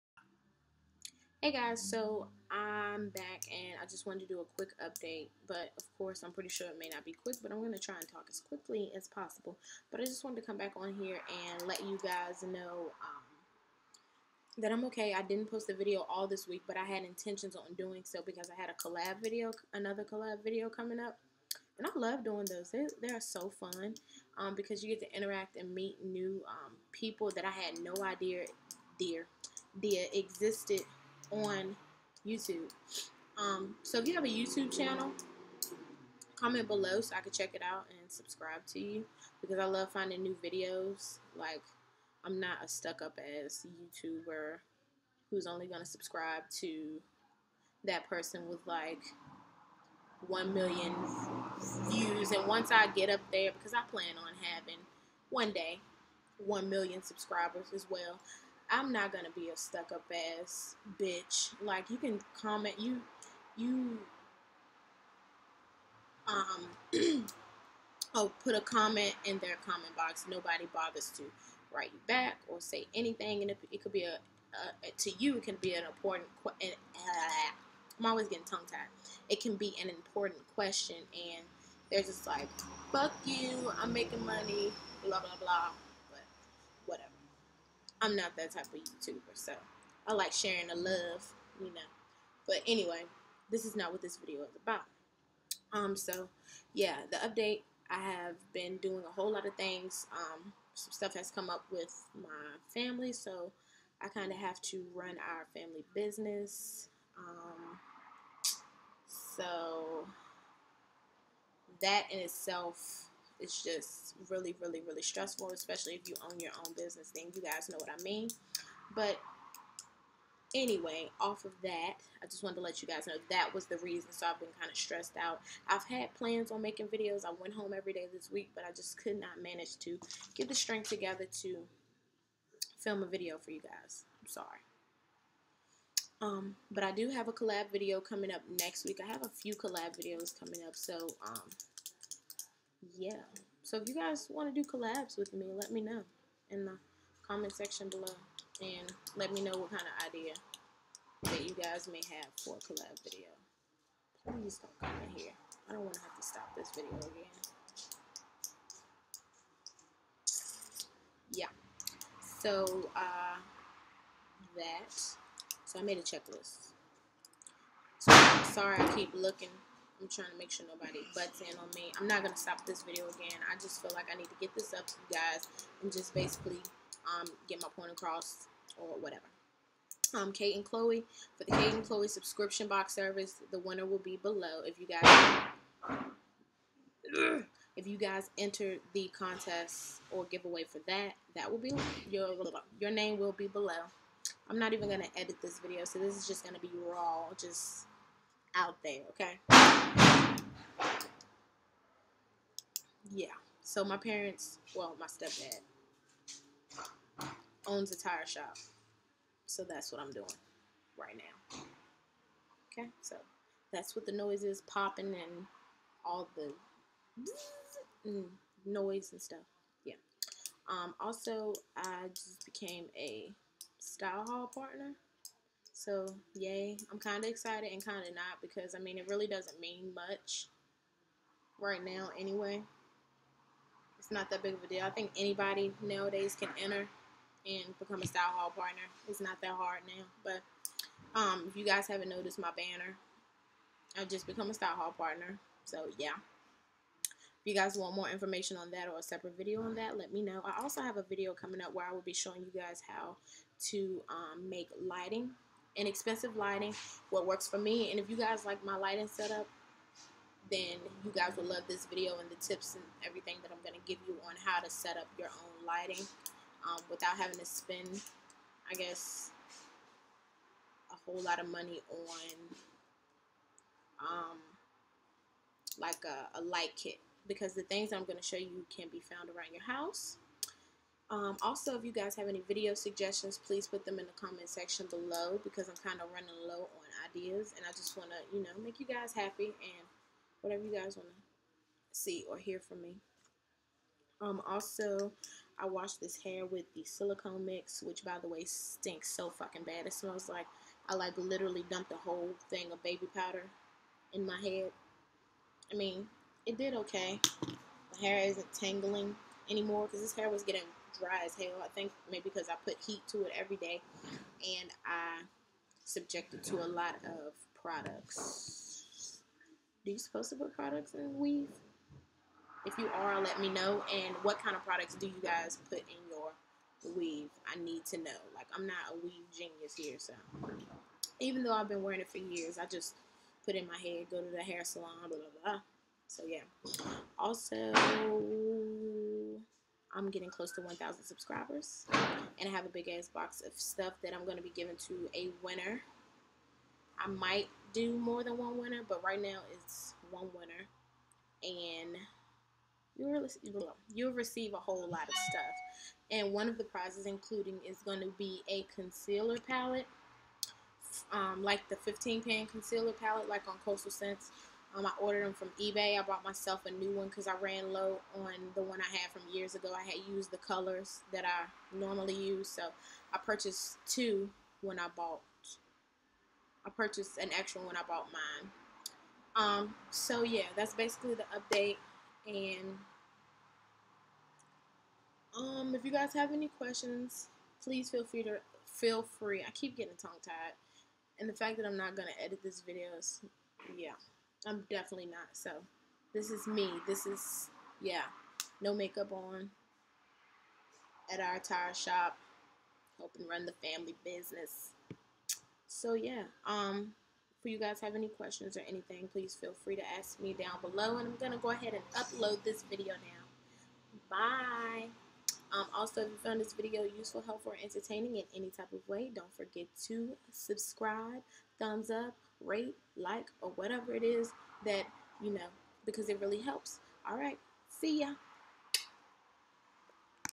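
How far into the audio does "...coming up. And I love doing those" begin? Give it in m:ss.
0:20.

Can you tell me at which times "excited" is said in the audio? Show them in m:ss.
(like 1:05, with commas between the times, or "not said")
3:47.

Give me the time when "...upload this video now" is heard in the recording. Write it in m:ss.
6:51.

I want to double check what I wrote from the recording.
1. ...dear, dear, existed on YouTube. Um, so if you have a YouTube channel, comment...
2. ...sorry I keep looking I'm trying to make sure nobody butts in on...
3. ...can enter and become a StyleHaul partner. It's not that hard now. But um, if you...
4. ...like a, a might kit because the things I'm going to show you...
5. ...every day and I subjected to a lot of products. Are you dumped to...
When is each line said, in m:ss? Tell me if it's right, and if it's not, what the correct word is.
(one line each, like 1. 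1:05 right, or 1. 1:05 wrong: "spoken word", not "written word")
1. 0:28 right
2. 2:48 right
3. 3:56 right
4. 4:35 wrong: "light", not "might"
5. 5:13 wrong: "supposed", not "dumped".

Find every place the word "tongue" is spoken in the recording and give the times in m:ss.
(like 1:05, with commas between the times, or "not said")
1:18, 6:30.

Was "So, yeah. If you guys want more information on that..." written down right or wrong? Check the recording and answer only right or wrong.
right.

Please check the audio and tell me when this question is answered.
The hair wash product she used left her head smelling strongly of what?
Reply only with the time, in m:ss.
5:02.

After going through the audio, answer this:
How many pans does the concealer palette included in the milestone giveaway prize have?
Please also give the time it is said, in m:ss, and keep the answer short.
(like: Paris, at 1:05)
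15, at 6:01.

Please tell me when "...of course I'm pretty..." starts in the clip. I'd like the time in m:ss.
0:05.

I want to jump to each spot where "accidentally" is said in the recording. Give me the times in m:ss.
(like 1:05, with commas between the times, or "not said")
not said.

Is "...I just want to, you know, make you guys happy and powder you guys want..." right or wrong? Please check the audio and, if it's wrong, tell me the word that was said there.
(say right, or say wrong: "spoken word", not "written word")
wrong: "whatever", not "powder".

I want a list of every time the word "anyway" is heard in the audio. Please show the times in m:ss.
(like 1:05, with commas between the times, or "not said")
1:32, 2:00, 3:52.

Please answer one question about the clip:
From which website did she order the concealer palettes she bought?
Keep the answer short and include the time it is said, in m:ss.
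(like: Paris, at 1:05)
eBay, at 6:05.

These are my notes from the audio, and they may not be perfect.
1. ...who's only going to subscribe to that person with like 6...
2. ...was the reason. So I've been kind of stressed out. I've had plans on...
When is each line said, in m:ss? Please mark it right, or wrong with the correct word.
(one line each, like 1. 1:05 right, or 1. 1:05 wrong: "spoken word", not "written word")
1. 0:45 wrong: "1", not "6"
2. 2:03 right.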